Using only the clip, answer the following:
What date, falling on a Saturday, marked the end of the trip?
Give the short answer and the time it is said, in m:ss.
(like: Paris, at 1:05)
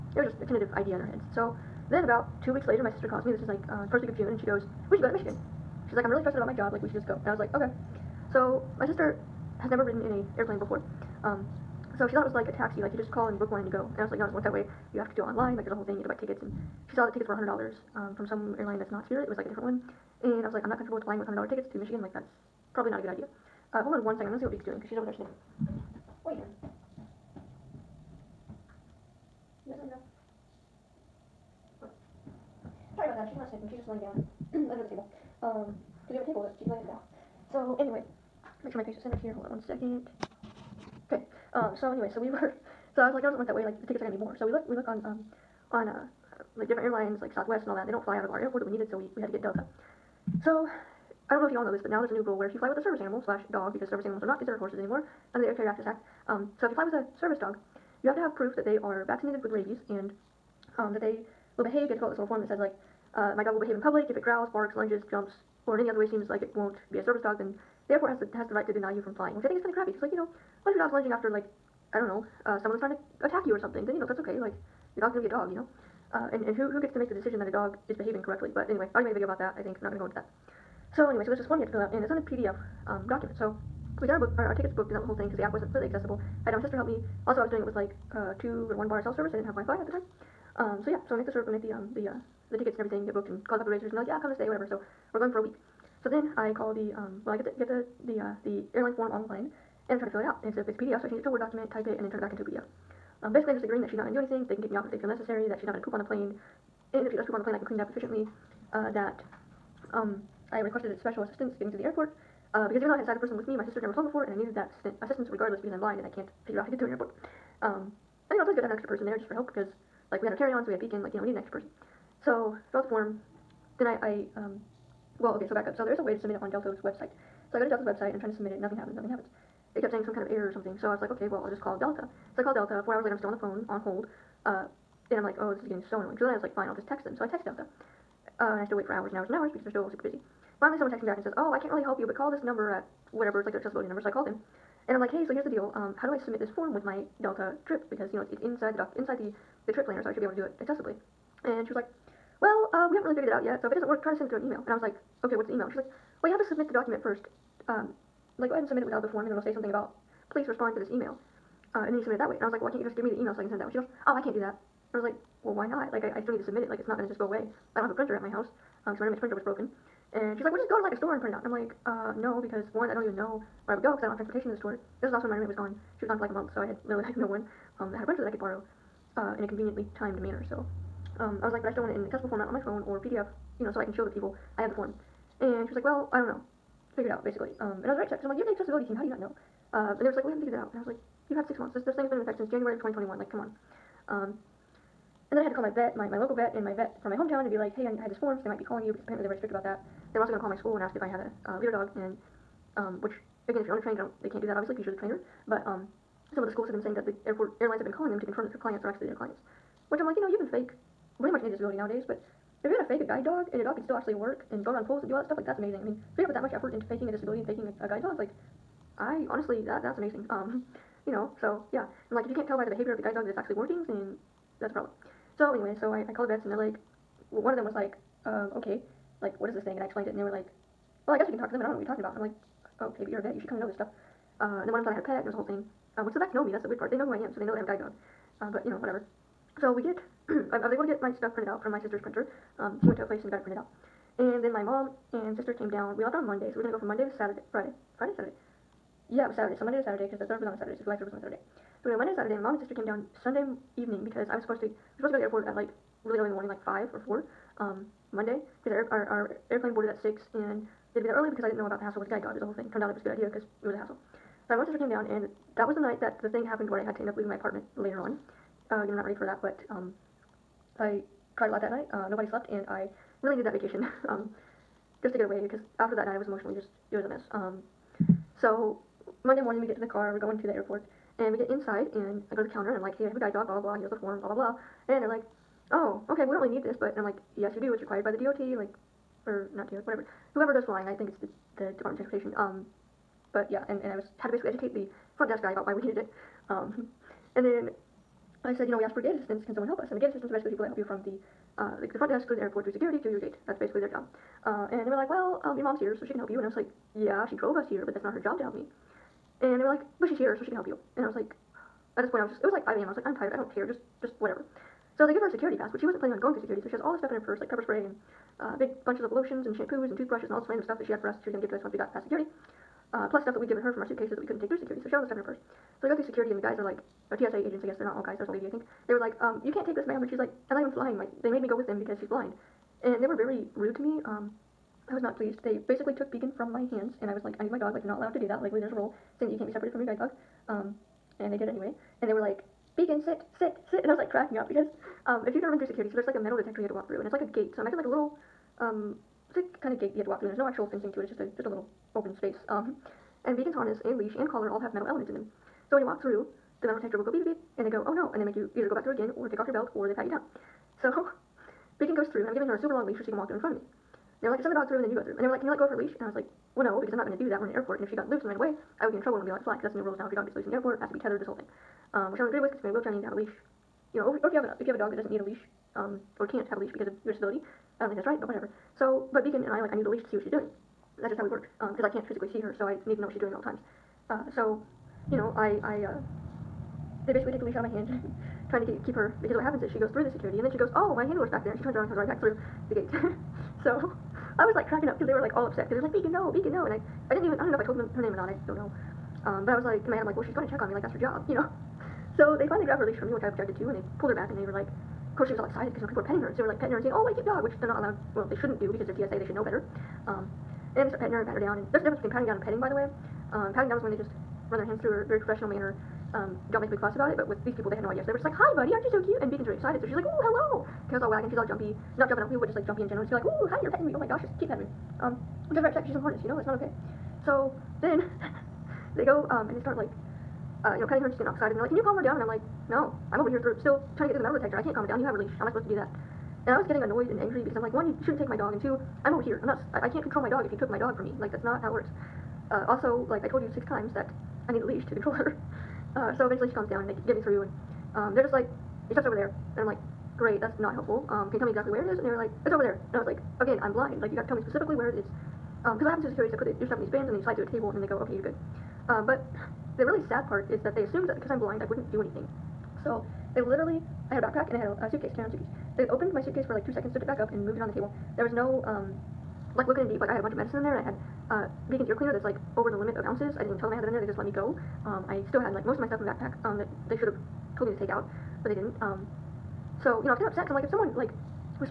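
July 3rd, at 4:10.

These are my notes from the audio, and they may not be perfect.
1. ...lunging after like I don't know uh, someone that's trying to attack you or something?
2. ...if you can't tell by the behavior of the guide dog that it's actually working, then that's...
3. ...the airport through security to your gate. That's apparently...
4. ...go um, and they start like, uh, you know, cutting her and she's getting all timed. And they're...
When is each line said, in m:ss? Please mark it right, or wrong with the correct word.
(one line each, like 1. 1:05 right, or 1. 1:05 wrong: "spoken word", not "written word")
1. 1:10 right
2. 3:42 right
3. 5:02 wrong: "basically", not "apparently"
4. 7:09 wrong: "excited", not "timed".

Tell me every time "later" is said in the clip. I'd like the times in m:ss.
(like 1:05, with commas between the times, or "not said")
0:02, 2:13, 4:27.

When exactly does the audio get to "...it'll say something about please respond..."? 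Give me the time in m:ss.
2:39.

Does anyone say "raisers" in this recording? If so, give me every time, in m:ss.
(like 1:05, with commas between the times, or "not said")
1:33.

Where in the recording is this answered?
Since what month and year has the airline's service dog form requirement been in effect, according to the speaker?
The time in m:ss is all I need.
3:12.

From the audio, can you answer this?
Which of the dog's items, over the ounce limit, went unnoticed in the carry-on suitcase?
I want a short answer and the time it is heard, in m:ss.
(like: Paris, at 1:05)
Ear cleaner, at 7:51.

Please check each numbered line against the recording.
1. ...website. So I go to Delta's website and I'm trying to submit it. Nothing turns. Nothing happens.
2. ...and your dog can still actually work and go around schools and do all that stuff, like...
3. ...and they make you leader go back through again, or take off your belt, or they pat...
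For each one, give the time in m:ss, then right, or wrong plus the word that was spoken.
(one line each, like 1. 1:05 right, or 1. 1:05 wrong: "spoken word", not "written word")
1. 2:06 wrong: "happens", not "turns"
2. 3:33 wrong: "pools", not "schools"
3. 5:58 wrong: "either", not "leader".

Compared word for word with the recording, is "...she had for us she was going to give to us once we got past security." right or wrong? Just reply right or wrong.
right.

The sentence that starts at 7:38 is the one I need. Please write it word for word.
Um, but the really sad part is that they assumed that because I'm blind, I wouldn't do anything.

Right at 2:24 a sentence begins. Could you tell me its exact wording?
So I called him and I'm like, hey, so here's the deal.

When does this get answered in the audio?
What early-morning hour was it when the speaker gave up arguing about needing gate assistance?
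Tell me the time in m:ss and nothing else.
5:12.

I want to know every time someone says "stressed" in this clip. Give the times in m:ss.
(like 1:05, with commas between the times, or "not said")
0:06.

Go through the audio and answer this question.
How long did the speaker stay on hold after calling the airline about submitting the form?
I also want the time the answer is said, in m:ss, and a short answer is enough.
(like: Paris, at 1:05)
Four hours, at 2:12.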